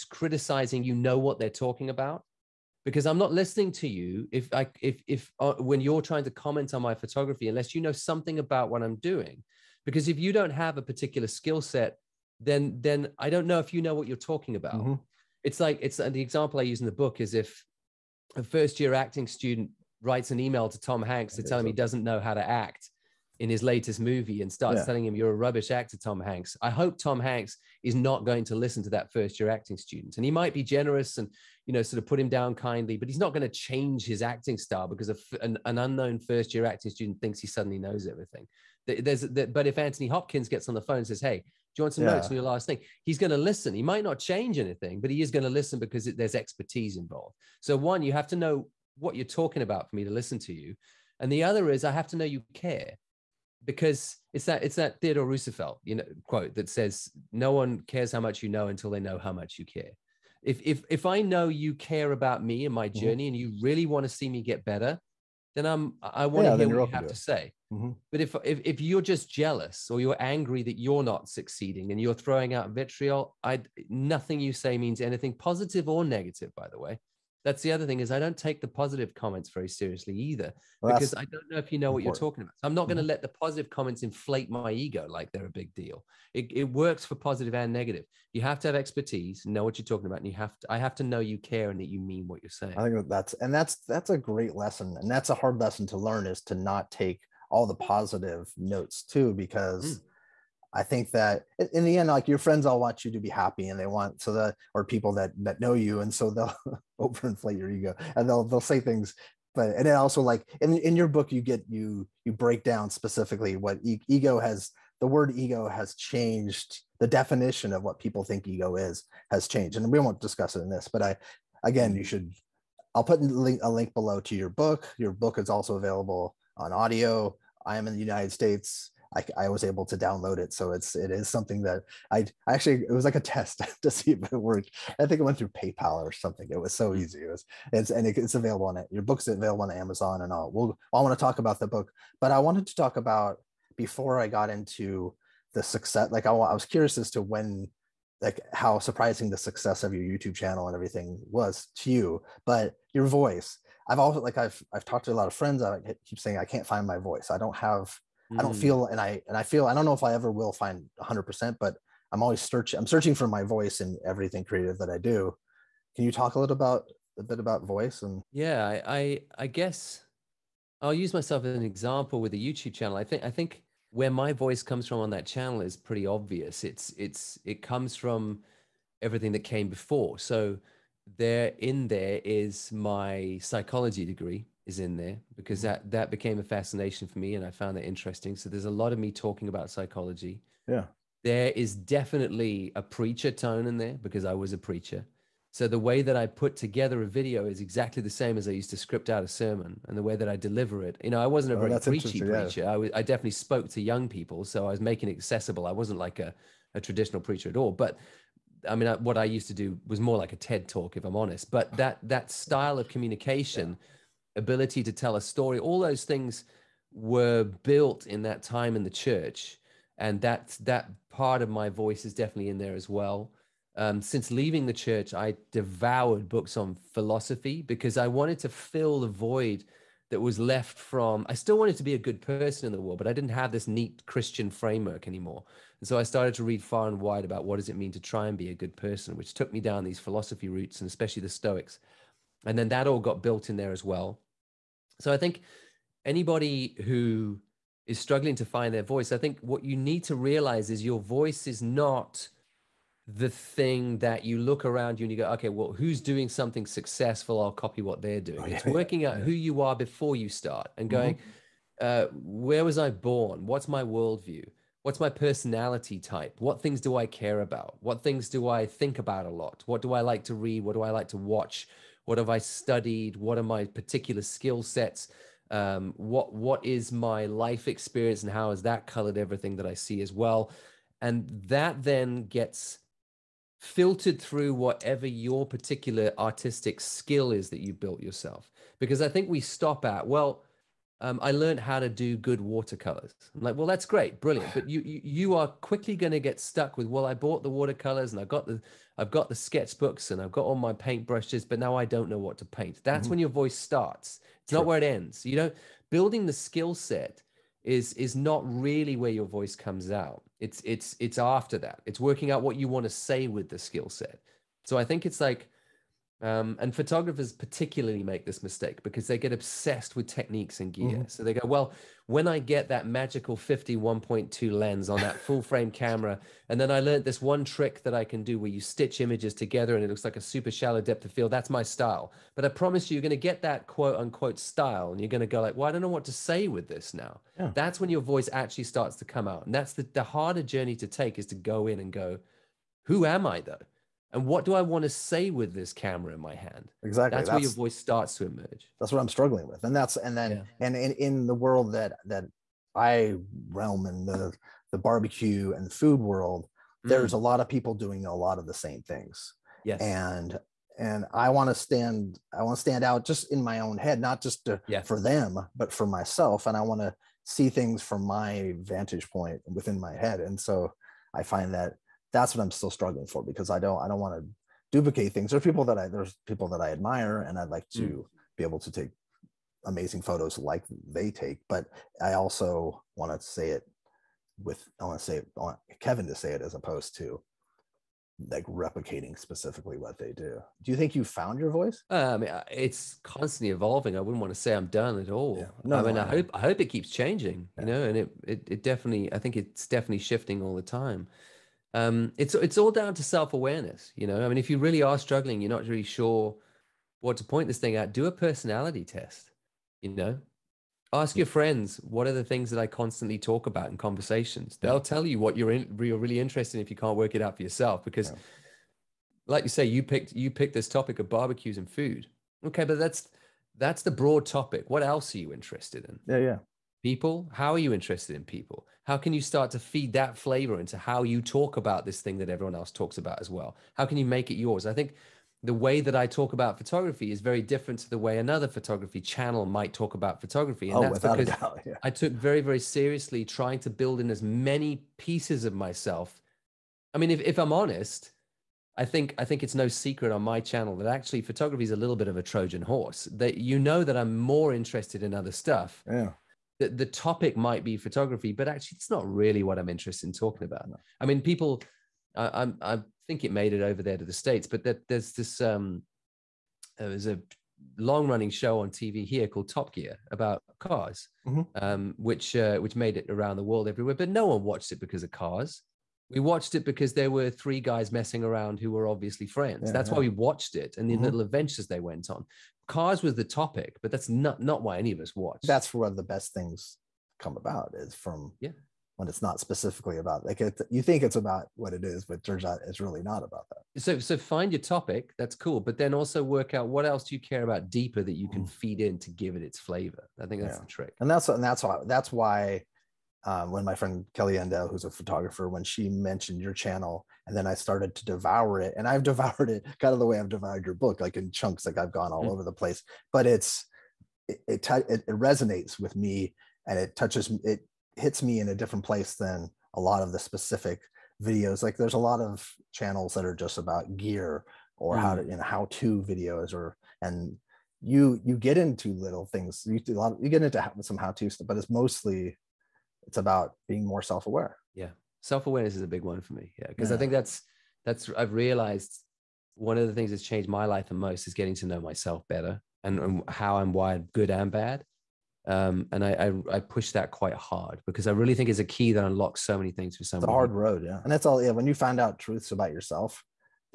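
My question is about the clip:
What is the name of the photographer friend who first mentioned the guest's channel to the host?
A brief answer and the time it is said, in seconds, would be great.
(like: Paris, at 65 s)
Kelly Endell, at 504 s.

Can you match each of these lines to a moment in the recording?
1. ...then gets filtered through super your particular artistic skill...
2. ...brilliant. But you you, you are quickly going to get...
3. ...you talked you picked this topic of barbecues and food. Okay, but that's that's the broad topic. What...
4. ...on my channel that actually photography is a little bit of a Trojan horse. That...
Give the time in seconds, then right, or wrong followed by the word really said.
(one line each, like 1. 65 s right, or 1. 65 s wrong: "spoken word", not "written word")
1. 281 s wrong: "whatever", not "super"
2. 294 s right
3. 419 s wrong: "picked", not "talked"
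4. 450 s right.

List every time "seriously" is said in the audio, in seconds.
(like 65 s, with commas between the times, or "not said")
79 s, 442 s.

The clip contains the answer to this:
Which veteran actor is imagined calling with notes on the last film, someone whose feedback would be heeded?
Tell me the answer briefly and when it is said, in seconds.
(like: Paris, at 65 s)
Anthony Hopkins, at 39 s.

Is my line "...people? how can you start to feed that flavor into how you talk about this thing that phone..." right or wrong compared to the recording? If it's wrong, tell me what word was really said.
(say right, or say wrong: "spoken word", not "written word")
wrong: "everyone", not "phone".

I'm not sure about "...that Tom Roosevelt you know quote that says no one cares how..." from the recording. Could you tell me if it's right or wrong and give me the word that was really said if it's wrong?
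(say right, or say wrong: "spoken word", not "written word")
wrong: "Theodore", not "Tom".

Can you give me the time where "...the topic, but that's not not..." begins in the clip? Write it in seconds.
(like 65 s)
483 s.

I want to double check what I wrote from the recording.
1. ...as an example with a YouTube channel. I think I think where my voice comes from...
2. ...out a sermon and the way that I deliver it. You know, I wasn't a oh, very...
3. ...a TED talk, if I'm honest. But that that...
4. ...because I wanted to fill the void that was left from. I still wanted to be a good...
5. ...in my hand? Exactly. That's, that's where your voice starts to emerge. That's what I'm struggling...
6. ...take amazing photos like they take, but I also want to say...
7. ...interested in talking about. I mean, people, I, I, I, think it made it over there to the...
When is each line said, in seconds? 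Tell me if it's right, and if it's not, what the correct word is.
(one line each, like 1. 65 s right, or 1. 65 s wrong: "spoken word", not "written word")
1. 171 s right
2. 199 s right
3. 210 s right
4. 227 s right
5. 346 s right
6. 378 s right
7. 459 s right.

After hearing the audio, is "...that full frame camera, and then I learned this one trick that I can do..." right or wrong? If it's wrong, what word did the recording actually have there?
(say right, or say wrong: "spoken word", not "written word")
right.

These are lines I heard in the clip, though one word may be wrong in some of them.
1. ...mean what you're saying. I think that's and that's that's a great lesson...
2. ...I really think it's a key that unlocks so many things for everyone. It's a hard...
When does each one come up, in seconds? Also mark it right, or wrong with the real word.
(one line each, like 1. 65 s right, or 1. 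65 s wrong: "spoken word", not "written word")
1. 92 s right
2. 548 s wrong: "someone", not "everyone".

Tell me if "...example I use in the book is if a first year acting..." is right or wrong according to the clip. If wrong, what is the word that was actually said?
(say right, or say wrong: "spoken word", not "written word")
right.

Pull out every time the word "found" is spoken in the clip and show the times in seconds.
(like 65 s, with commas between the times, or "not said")
187 s, 391 s.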